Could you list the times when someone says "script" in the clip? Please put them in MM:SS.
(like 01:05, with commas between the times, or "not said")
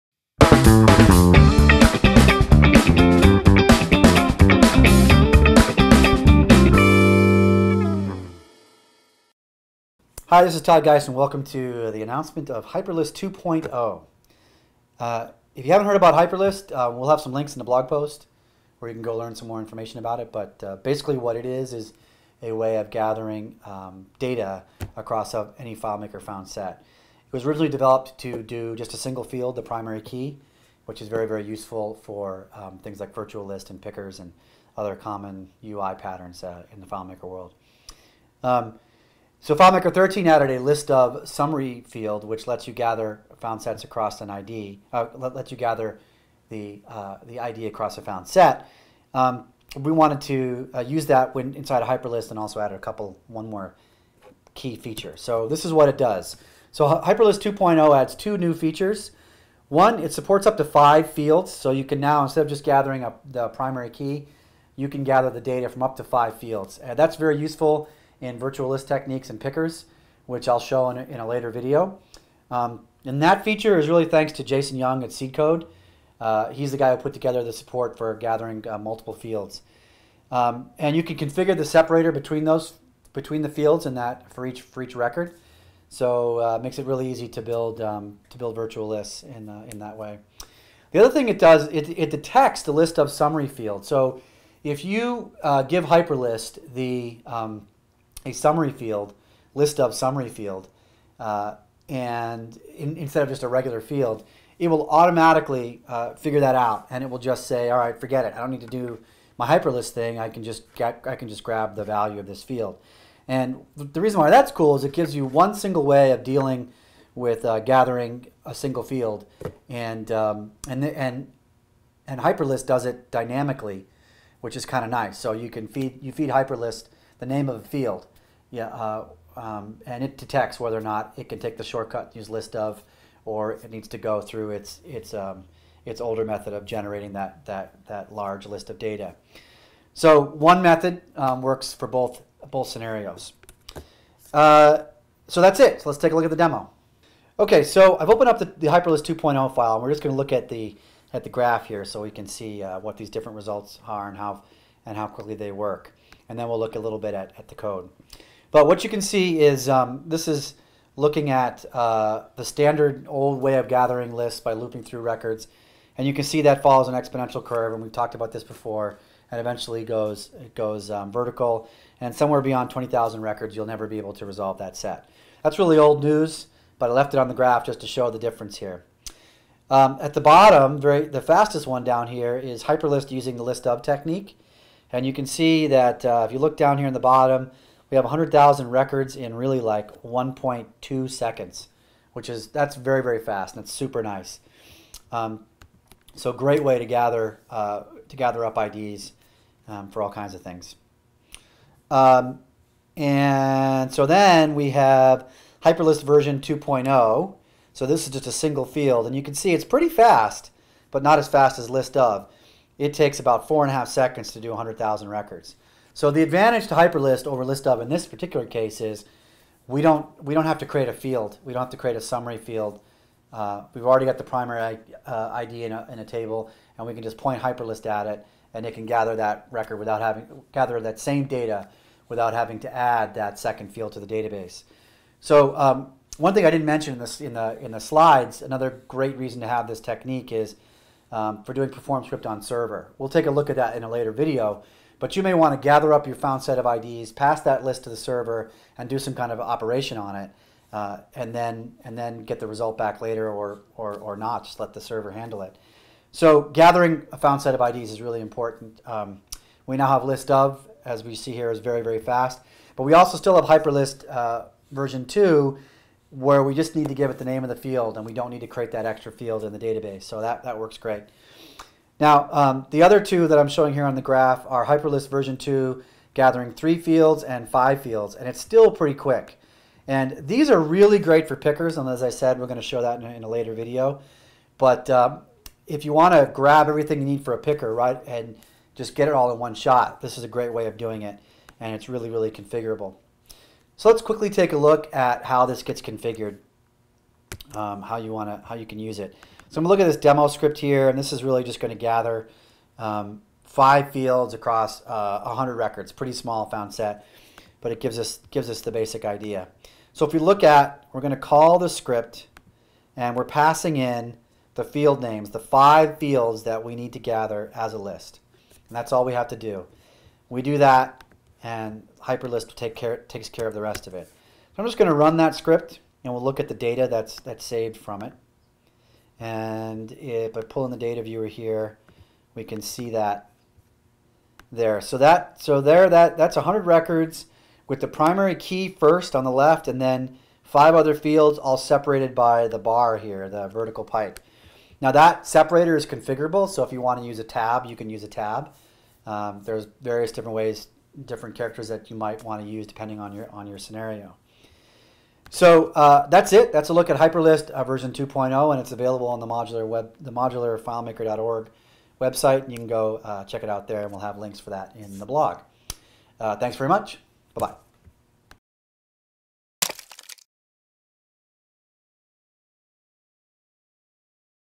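04:02, 05:00, 05:11, 05:25.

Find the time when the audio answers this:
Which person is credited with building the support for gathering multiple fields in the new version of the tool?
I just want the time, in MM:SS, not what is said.
01:14.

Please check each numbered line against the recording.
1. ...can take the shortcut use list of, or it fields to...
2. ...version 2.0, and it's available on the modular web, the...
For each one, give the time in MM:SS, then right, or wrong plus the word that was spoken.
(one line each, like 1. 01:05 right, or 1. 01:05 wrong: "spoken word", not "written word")
1. 02:11 wrong: "needs", not "fields"
2. 05:57 right.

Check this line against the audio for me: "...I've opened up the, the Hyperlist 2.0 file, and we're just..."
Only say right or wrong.
right.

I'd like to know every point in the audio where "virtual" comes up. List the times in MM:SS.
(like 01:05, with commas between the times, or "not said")
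00:33, 01:08, 01:28.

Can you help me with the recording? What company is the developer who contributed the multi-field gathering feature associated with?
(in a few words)
Seedcode.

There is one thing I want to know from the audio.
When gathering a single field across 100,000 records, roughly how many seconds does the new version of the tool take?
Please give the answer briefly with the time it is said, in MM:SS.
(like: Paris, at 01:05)
4.5 seconds, at 03:33.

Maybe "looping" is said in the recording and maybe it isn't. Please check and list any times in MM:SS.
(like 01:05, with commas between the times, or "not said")
02:44.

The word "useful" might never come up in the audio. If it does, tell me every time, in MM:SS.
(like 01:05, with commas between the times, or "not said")
00:31, 01:07.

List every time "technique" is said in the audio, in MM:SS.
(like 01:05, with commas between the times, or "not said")
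01:08, 03:03, 03:59.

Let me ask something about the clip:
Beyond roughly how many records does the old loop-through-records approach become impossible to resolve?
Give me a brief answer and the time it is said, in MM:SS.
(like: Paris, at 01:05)
20,000, at 02:52.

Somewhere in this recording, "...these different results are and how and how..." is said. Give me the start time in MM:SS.
02:32.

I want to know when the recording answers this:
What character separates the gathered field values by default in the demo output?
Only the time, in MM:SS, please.
05:43.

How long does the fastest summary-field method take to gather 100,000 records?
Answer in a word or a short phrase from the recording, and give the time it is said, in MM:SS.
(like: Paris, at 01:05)
1.2 seconds, at 03:10.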